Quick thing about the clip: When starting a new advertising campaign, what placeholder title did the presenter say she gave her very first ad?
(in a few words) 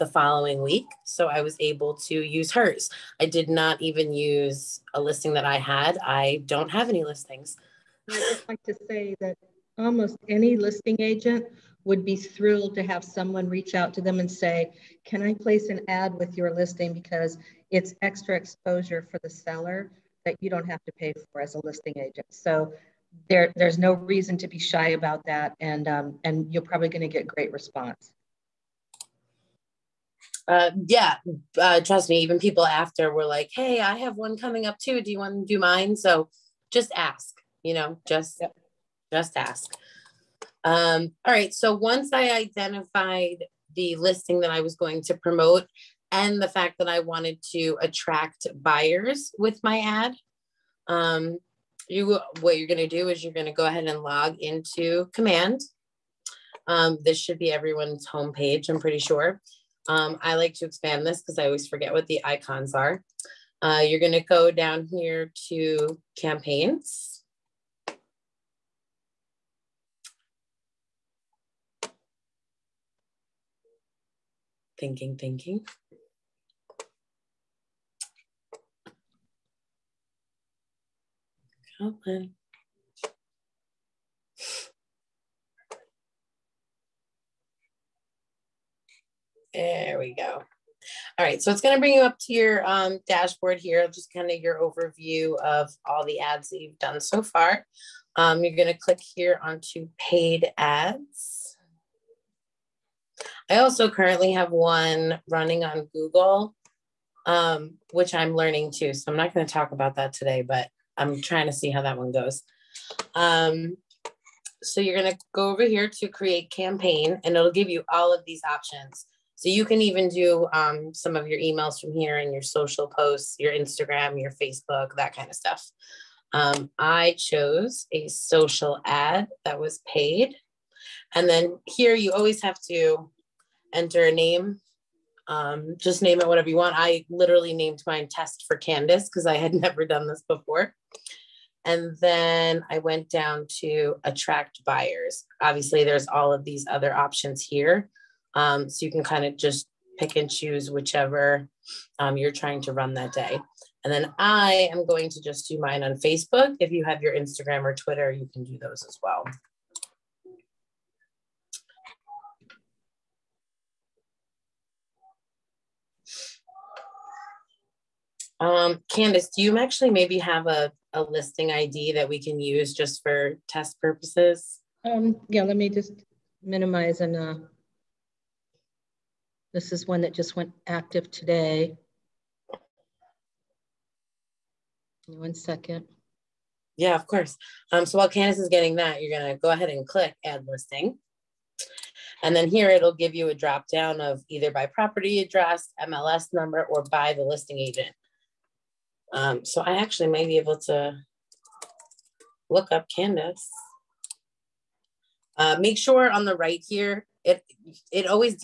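test for Candace.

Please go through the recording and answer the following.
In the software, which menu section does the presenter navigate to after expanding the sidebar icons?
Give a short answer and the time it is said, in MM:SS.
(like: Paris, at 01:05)
campaigns, at 01:06.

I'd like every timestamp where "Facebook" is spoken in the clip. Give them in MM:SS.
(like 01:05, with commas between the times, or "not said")
02:04, 02:35.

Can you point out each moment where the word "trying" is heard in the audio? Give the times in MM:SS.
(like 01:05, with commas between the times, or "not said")
01:51, 02:32.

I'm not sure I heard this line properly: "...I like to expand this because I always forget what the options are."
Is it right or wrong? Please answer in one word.
wrong.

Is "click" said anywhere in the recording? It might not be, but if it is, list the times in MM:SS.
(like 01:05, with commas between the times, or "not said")
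01:38, 03:09.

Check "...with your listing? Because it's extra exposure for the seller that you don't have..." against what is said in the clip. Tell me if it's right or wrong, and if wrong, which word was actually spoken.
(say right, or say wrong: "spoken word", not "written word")
right.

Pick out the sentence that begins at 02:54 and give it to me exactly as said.
Um, yeah, let me just minimize and uh, this is one that just went active today.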